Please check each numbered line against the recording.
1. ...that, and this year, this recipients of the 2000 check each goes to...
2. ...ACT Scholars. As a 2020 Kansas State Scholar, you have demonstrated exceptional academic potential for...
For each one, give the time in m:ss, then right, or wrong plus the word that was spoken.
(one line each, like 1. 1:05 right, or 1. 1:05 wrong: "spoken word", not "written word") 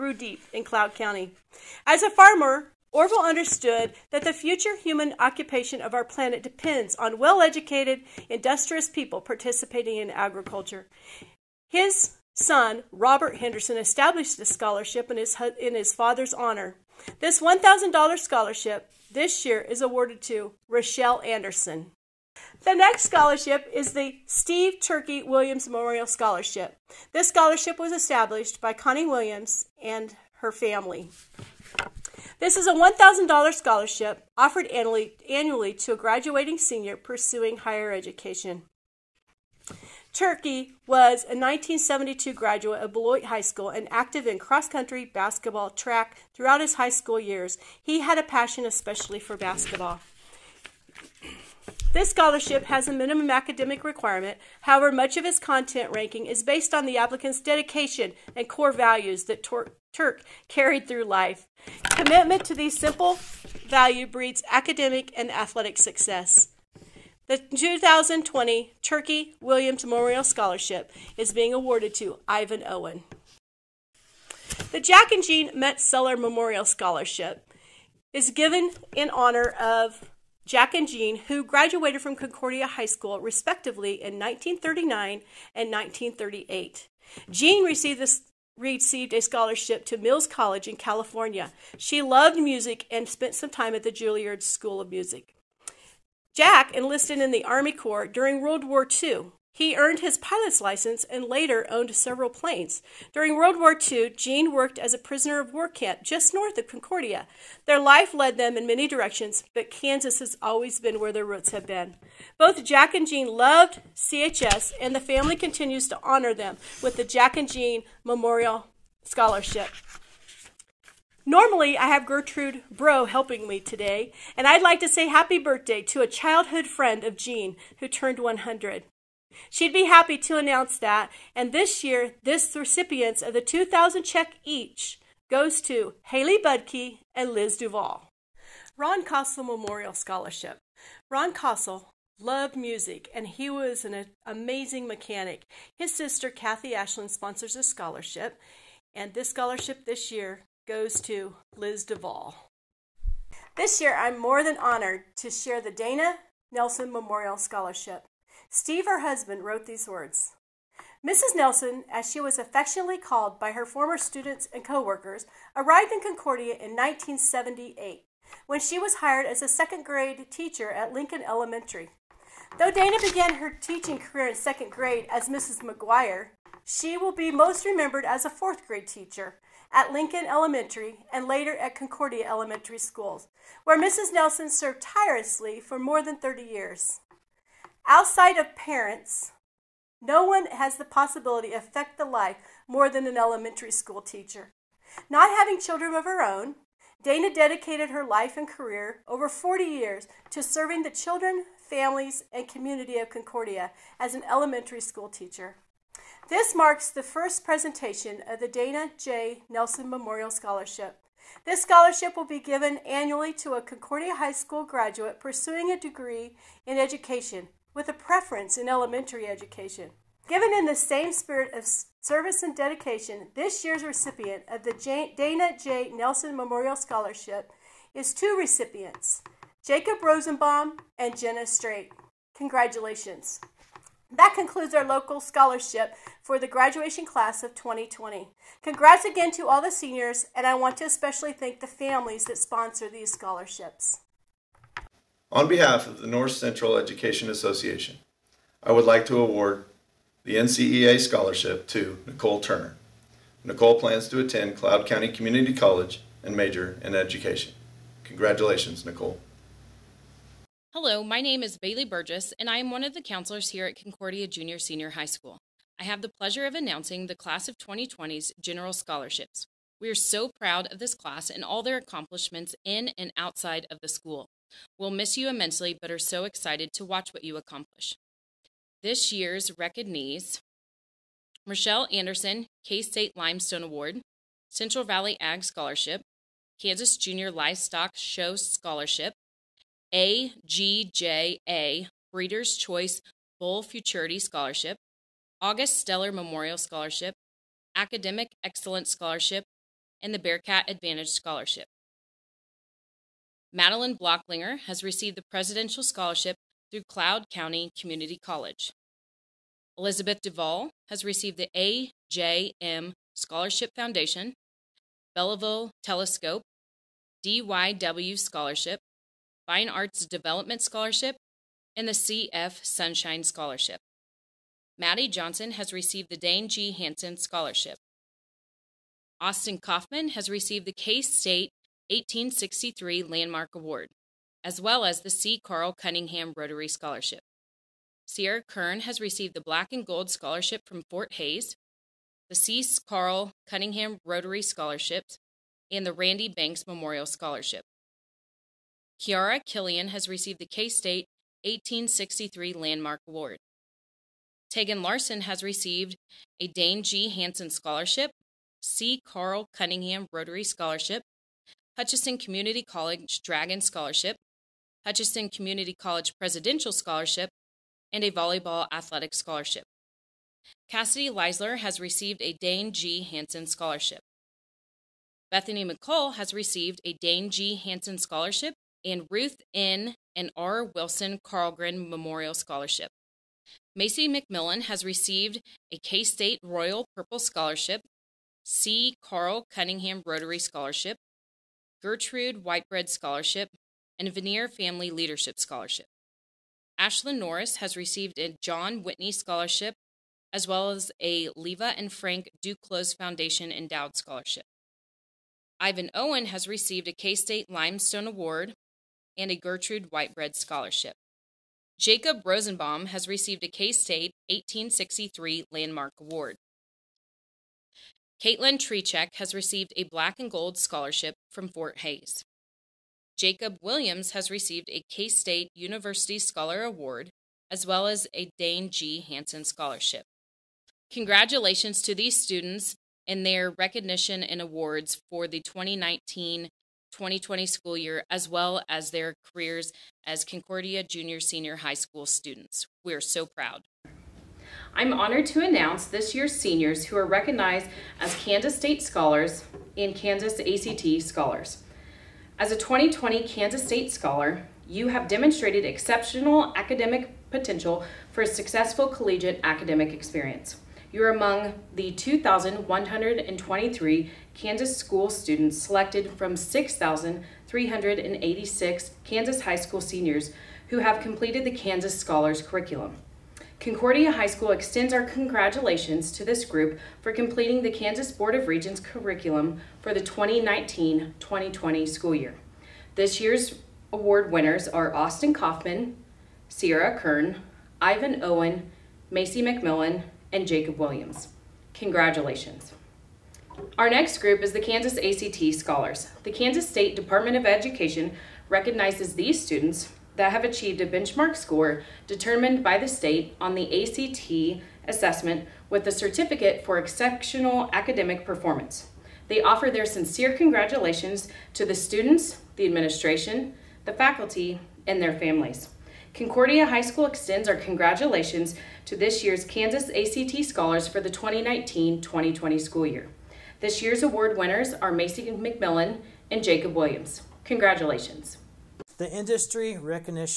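1. 2:10 right
2. 7:30 right.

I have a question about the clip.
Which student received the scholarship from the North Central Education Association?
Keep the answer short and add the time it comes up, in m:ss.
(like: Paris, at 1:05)
Nicole Turner, at 4:12.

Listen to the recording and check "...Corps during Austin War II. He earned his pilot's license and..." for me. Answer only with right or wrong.
wrong.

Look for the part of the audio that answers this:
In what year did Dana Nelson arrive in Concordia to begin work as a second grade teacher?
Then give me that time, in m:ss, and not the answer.
2:46.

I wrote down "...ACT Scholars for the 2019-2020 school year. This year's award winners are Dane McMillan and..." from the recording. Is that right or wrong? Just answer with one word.
wrong.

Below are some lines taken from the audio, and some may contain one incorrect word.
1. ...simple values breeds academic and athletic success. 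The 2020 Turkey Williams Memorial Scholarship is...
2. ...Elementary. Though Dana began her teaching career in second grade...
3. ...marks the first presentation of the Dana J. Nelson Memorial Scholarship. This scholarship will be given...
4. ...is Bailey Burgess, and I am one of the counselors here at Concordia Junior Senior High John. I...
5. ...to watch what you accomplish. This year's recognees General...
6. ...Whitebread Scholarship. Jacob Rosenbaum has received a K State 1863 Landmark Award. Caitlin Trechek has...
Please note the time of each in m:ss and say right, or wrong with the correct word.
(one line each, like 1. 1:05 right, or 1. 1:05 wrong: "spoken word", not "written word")
1. 1:02 right
2. 2:51 right
3. 3:26 right
4. 4:21 wrong: "School", not "John"
5. 4:36 wrong: "Michelle", not "General"
6. 6:49 right.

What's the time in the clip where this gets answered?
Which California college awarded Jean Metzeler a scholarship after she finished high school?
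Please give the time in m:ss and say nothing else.
1:29.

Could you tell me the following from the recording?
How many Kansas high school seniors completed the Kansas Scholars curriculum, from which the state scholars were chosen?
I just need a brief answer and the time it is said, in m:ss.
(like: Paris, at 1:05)
6,386, at 7:46.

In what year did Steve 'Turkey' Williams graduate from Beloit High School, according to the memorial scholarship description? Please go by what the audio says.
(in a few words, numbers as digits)
1972.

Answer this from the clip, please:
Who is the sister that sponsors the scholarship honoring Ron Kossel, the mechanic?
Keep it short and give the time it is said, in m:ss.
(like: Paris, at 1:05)
Kathy Ashland, at 2:26.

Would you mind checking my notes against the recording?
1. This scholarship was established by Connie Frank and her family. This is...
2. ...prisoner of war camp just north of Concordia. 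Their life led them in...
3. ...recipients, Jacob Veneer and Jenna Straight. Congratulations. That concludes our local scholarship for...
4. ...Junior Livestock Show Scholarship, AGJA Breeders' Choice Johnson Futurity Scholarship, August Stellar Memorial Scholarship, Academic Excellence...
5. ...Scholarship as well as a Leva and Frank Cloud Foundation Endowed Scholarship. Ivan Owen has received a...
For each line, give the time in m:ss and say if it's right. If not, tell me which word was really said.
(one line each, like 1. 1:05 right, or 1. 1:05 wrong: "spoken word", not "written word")
1. 0:27 wrong: "Williams", not "Frank"
2. 1:44 right
3. 3:48 wrong: "Rosenbaum", not "Veneer"
4. 4:46 wrong: "Bull", not "Johnson"
5. 6:39 wrong: "Duclos", not "Cloud".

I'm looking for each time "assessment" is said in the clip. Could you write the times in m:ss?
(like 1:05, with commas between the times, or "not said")
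8:24.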